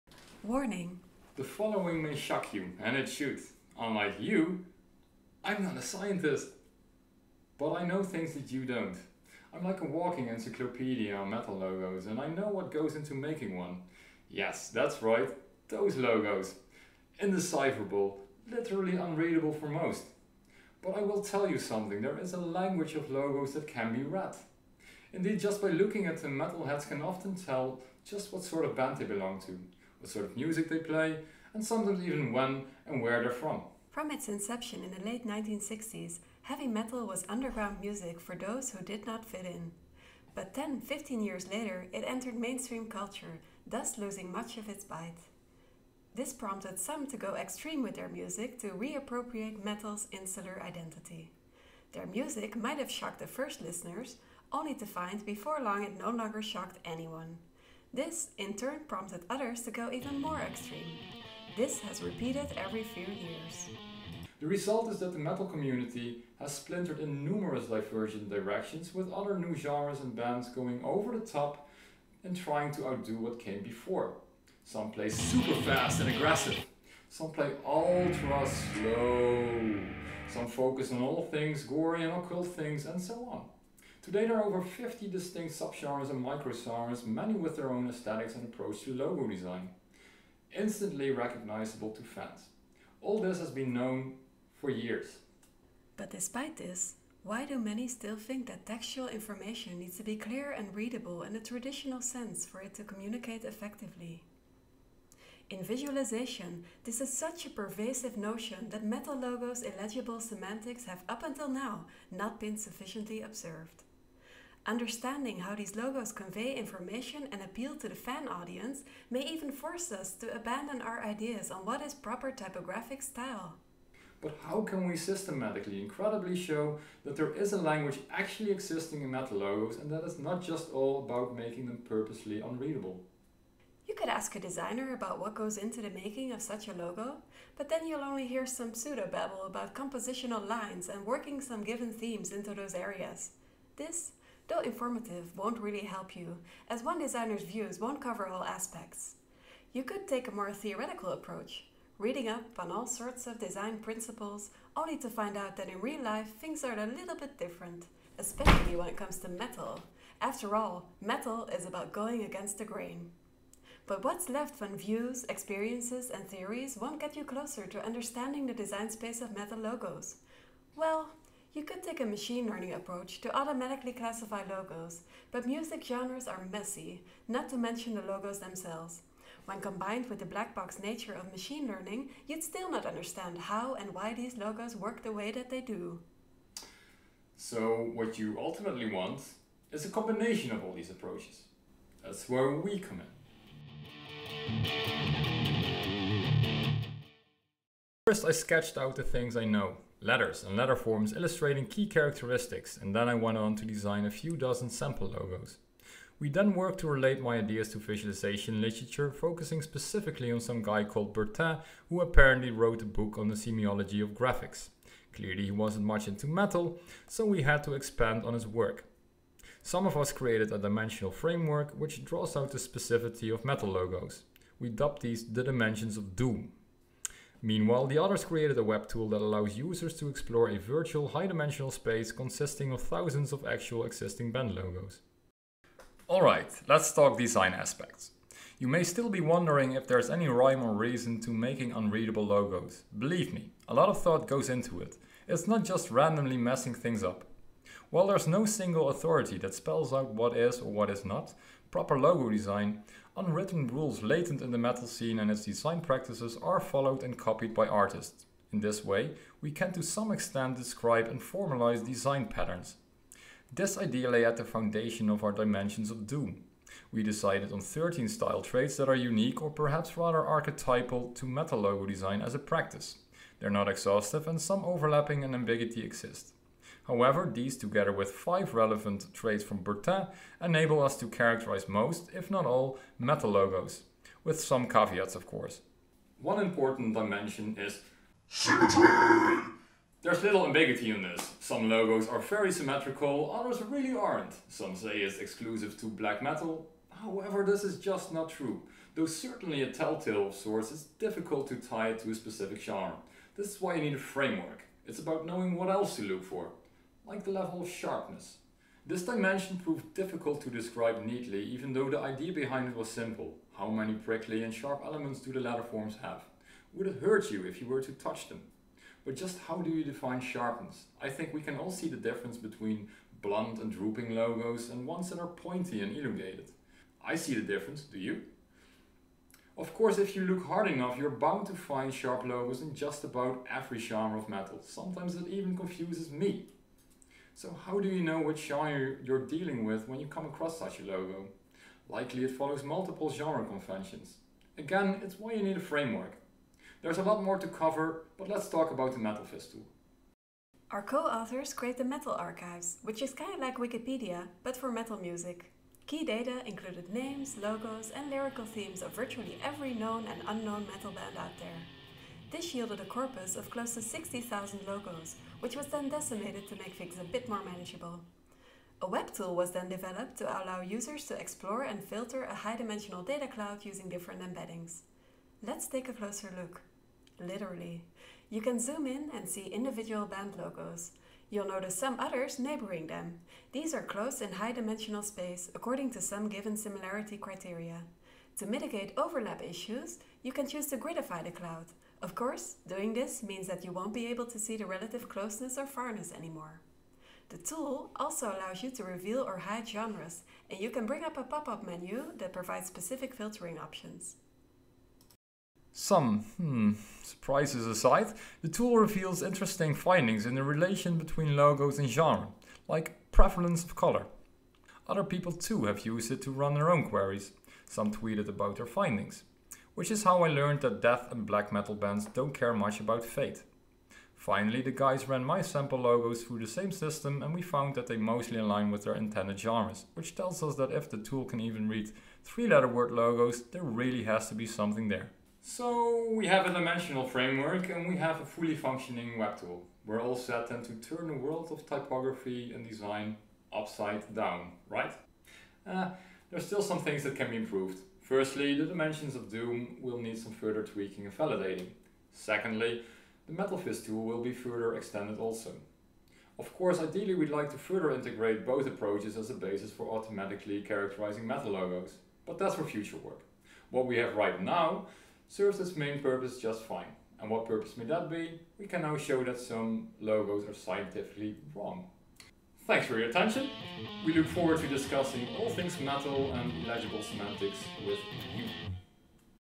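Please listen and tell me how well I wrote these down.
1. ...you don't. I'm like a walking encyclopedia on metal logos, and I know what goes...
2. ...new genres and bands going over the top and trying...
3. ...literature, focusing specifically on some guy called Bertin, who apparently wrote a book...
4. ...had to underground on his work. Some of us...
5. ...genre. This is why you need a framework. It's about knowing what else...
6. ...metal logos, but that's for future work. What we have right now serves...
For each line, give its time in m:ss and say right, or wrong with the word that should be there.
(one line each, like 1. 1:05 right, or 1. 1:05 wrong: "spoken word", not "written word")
1. 0:08 right
2. 1:09 right
3. 3:28 right
4. 3:37 wrong: "expand", not "underground"
5. 5:02 right
6. 7:41 right.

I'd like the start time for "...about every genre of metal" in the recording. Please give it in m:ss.
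5:33.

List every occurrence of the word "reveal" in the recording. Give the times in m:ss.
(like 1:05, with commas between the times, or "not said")
6:38, 6:48.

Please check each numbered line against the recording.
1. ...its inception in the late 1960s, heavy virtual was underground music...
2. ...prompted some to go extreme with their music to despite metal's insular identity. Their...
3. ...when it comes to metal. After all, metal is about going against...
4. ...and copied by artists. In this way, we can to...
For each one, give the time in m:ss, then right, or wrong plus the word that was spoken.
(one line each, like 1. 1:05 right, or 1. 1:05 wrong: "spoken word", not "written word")
1. 0:34 wrong: "metal", not "virtual"
2. 0:46 wrong: "reappropriate", not "despite"
3. 2:38 right
4. 4:17 right.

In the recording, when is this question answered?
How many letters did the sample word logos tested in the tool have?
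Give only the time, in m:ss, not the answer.
7:12.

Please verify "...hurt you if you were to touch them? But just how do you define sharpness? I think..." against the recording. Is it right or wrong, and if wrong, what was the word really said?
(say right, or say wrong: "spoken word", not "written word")
right.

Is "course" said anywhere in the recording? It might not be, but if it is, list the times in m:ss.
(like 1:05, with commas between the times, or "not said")
4:45, 5:29, 6:32, 7:36.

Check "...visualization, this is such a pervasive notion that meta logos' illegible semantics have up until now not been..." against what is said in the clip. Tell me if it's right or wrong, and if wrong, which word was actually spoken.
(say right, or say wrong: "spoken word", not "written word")
right.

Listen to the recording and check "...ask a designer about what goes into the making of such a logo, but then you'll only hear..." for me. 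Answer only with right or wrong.
right.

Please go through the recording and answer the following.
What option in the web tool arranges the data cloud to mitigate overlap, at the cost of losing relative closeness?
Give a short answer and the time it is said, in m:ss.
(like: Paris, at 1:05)
Gridify, at 6:30.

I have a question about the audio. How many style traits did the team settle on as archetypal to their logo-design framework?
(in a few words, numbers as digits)
13.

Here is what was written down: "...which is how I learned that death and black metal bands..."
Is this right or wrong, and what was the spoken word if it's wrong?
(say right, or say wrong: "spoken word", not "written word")
right.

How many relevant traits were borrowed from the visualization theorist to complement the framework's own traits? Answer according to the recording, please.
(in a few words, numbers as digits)
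5.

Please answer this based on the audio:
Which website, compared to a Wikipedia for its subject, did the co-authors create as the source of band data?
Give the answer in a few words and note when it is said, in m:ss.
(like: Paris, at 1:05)
Metal Archives, at 5:51.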